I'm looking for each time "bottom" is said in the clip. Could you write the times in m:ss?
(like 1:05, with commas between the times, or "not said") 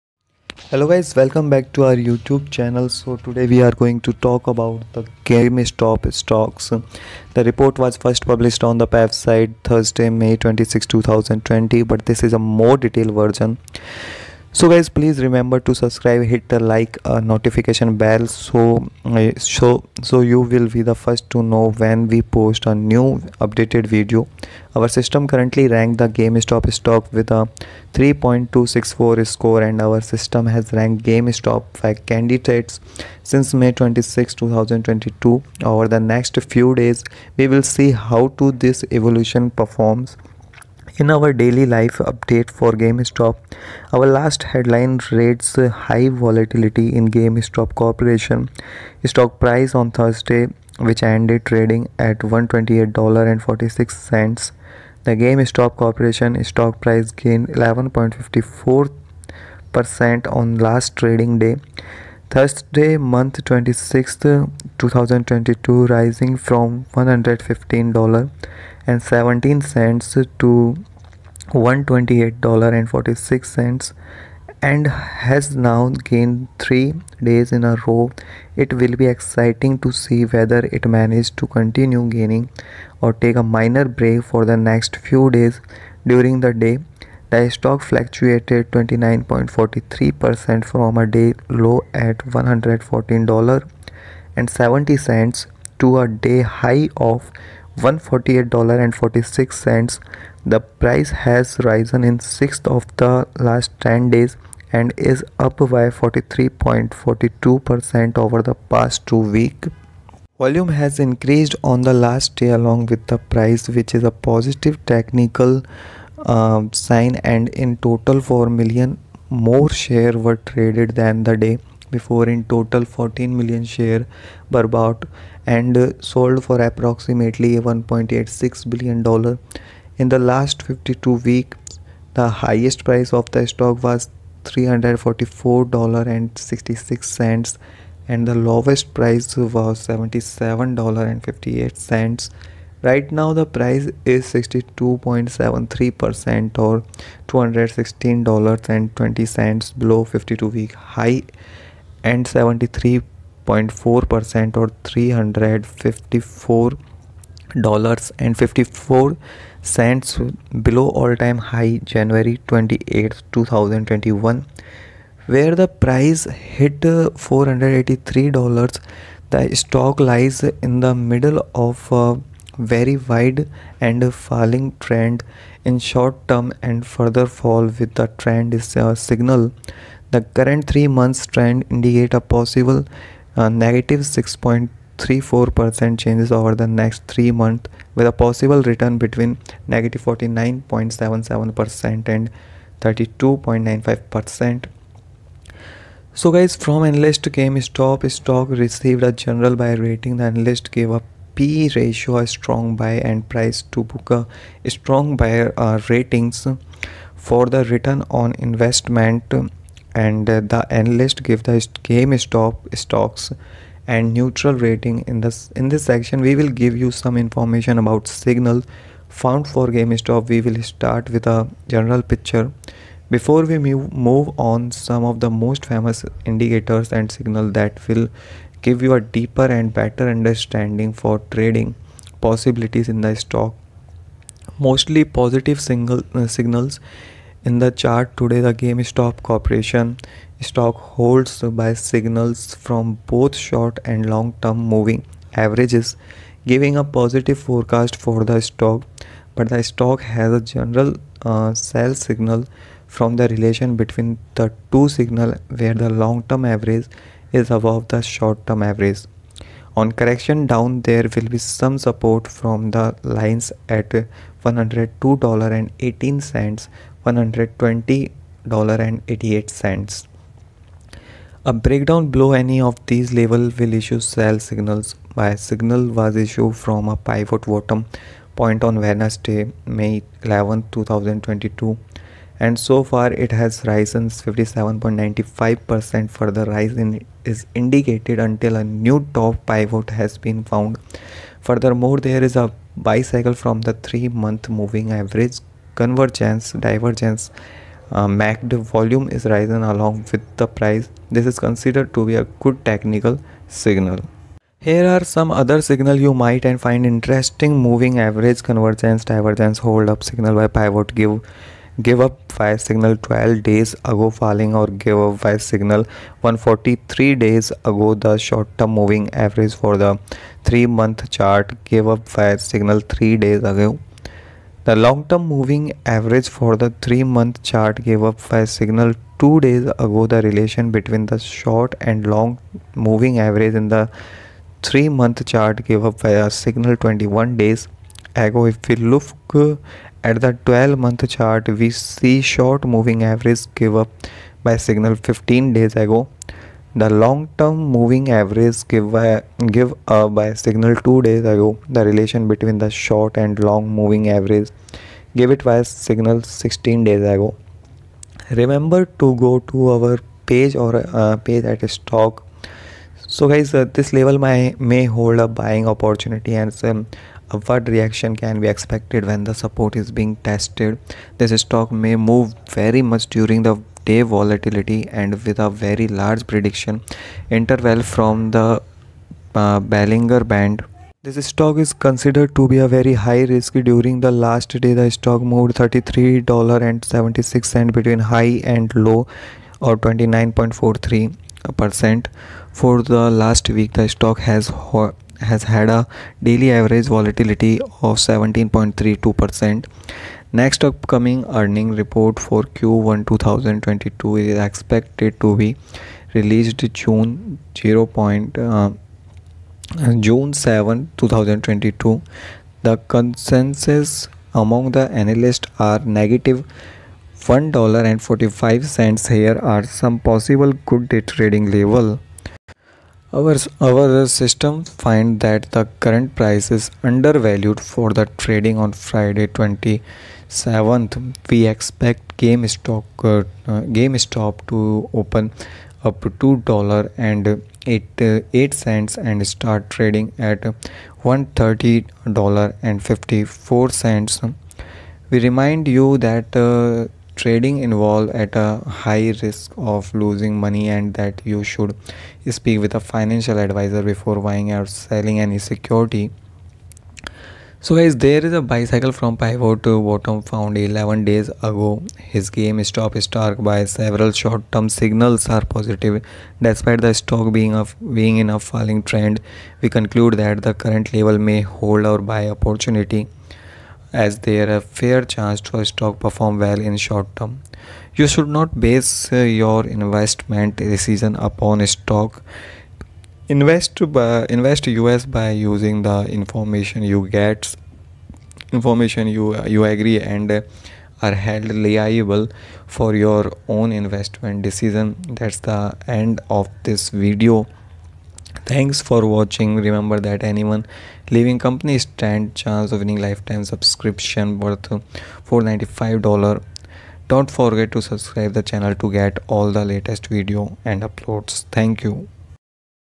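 4:37, 7:39.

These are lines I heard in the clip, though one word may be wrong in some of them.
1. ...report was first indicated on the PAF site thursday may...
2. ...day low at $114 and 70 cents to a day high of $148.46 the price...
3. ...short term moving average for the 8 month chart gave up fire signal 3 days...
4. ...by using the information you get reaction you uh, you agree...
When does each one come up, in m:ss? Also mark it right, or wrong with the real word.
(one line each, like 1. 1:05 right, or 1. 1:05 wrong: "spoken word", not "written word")
1. 0:07 wrong: "published", not "indicated"
2. 1:31 right
3. 5:18 wrong: "3", not "8"
4. 8:05 wrong: "information", not "reaction".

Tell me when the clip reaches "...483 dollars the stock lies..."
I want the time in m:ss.
2:47.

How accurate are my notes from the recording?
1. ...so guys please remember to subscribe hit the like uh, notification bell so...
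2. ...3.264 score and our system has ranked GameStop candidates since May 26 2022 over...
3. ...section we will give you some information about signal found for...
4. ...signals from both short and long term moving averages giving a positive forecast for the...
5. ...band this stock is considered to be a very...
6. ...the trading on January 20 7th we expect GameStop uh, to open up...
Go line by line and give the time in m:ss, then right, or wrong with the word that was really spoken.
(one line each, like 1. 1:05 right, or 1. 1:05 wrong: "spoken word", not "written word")
1. 0:14 right
2. 0:27 right
3. 3:35 right
4. 4:01 right
5. 6:19 right
6. 7:07 wrong: "Friday", not "January".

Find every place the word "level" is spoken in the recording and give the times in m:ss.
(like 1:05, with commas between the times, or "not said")
4:33, 6:03, 7:01, 7:50.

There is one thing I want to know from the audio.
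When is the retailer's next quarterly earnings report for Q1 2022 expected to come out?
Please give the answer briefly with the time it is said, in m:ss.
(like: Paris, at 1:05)
June 7, 2022, at 6:49.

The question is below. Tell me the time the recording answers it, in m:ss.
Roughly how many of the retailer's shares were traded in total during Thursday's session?
2:02.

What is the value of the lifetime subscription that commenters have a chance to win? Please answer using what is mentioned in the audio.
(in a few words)
$495.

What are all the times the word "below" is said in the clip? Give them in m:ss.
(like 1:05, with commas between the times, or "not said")
2:29, 2:40, 4:32.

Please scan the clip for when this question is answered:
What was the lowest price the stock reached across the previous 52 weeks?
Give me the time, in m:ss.
2:19.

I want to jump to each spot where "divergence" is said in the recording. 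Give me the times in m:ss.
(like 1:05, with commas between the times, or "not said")
4:56, 5:09.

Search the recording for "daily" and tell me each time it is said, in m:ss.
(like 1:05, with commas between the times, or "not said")
0:41, 6:36.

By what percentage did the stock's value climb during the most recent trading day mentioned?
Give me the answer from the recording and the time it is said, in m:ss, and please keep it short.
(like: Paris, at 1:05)
11.54%, at 0:57.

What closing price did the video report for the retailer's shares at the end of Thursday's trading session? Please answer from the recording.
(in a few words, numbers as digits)
$128.46.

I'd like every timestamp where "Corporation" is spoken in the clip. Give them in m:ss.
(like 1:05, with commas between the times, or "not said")
0:47, 0:55, 3:59.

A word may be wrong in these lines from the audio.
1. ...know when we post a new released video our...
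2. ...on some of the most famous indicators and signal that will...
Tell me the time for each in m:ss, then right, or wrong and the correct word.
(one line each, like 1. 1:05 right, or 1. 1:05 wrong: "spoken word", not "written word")
1. 0:21 wrong: "updated", not "released"
2. 3:44 right.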